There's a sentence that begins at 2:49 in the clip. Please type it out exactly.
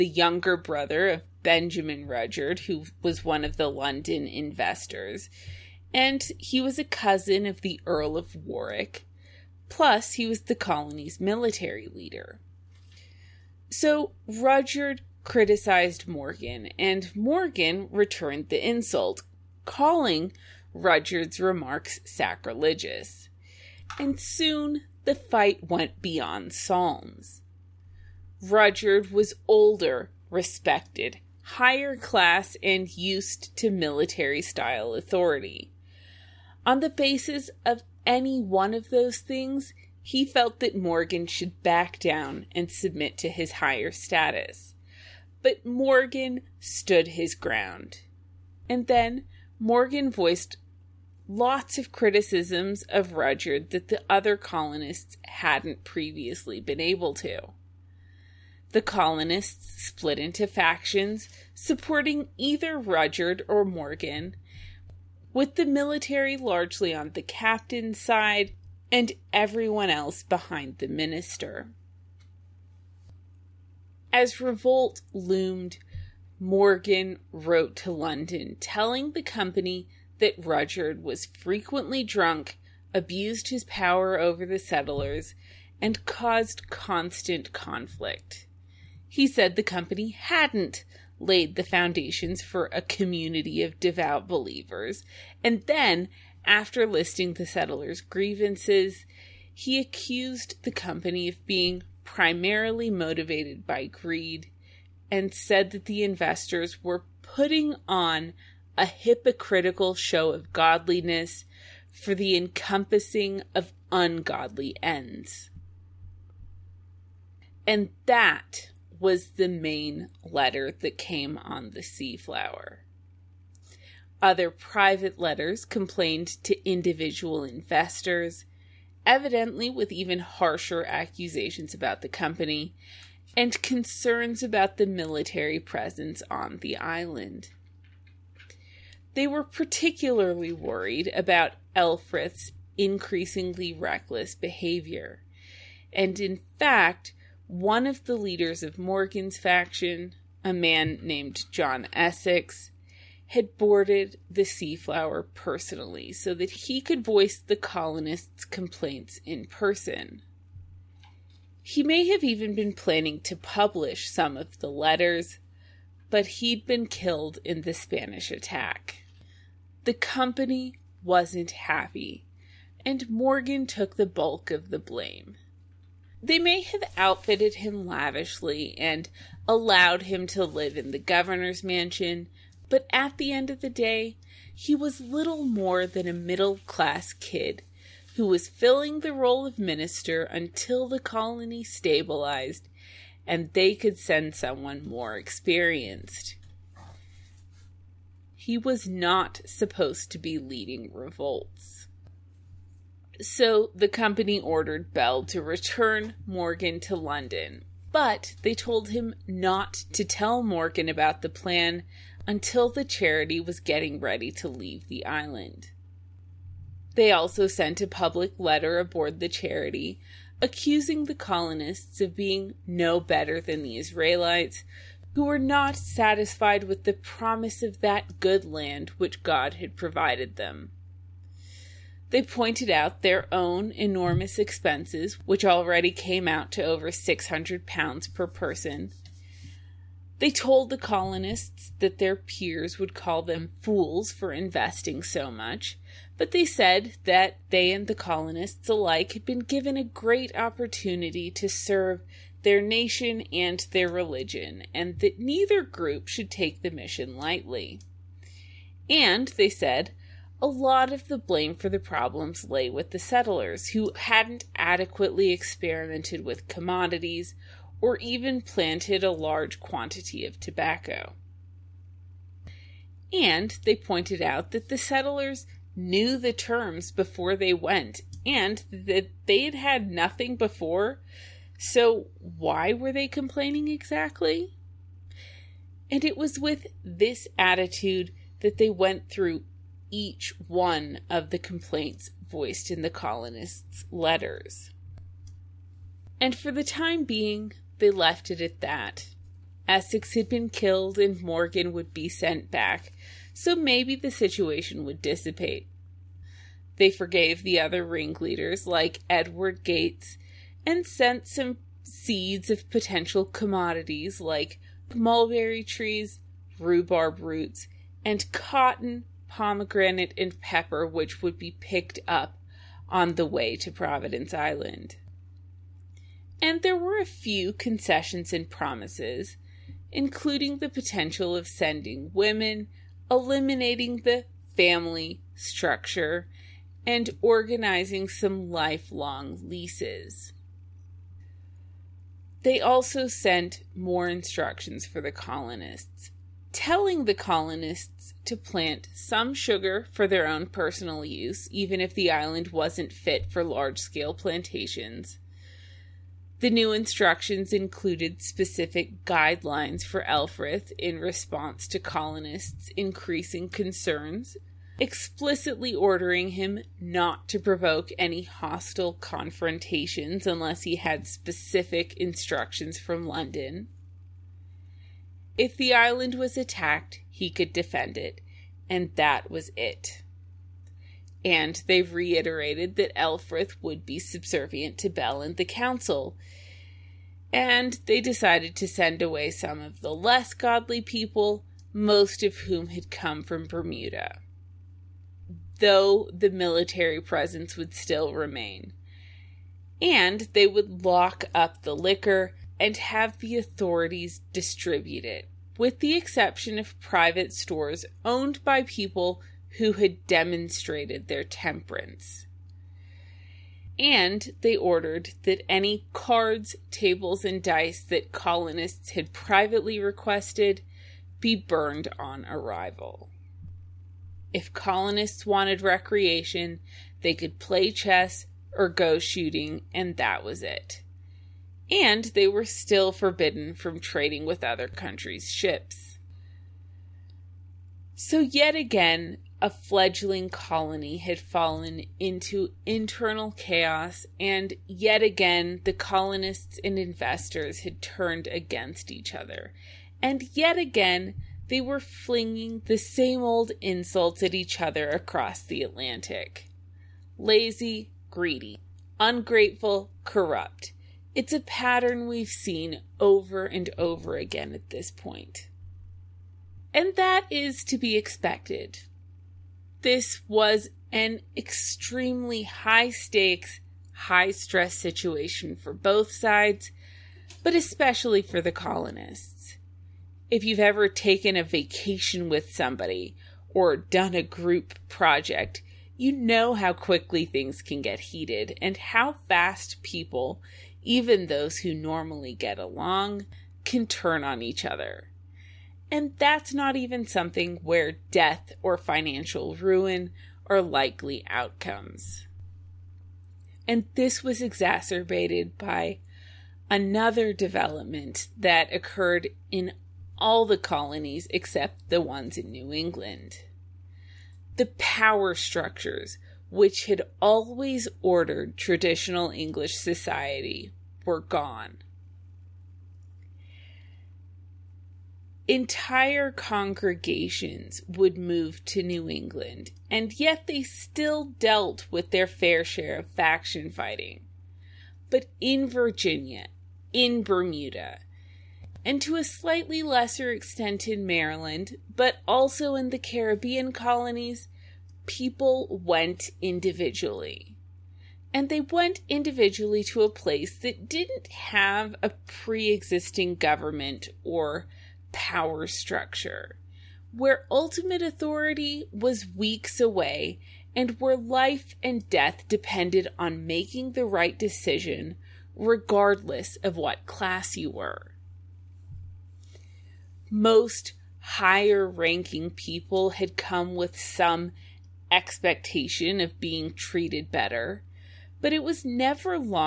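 The company wasn't happy, and Morgan took the bulk of the blame.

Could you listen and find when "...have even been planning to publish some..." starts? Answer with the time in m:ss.
2:42.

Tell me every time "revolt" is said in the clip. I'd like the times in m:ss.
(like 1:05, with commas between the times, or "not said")
1:14, 3:20.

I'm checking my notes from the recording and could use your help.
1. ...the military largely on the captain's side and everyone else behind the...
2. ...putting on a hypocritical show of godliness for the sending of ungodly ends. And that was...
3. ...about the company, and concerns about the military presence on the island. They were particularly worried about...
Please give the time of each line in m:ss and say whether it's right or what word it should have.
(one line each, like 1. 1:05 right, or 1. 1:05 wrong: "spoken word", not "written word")
1. 1:05 right
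2. 1:47 wrong: "encompassing", not "sending"
3. 2:11 right.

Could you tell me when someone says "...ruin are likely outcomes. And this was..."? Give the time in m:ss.
8:19.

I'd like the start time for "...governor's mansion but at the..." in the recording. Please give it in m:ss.
3:00.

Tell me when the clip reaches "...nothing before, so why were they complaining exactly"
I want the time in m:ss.
4:39.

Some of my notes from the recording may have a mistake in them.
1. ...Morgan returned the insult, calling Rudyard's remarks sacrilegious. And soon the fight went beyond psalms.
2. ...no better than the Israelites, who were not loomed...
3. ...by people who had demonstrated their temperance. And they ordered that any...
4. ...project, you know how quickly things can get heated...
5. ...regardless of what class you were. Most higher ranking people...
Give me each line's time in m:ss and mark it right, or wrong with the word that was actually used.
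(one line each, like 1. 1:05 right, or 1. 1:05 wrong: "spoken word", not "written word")
1. 0:17 right
2. 3:42 wrong: "satisfied", not "loomed"
3. 6:48 right
4. 8:04 right
5. 9:25 right.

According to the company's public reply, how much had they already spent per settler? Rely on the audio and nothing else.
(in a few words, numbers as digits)
600 pounds.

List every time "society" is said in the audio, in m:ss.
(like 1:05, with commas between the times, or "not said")
8:39.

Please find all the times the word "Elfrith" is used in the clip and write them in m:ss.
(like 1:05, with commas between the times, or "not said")
2:21, 6:00, 6:22.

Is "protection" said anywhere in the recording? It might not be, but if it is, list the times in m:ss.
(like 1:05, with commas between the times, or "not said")
not said.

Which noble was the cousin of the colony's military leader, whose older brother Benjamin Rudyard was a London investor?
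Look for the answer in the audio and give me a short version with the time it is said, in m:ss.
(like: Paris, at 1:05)
Earl of Warwick, at 0:07.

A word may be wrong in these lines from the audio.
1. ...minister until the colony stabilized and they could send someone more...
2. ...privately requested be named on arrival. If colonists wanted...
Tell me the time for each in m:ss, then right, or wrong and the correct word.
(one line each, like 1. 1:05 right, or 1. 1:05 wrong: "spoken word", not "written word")
1. 3:09 right
2. 6:59 wrong: "burned", not "named".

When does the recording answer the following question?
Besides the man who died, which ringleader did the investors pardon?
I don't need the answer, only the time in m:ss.
5:09.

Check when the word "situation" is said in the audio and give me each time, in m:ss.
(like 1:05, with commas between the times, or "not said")
5:04, 7:54.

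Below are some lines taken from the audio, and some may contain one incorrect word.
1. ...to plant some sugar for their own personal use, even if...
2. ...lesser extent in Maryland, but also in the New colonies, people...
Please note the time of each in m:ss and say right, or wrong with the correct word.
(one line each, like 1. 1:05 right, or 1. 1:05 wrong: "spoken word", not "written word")
1. 5:48 right
2. 8:59 wrong: "Caribbean", not "New".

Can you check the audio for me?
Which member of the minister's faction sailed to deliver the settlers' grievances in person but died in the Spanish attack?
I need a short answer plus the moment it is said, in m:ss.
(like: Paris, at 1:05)
John Essex, at 2:31.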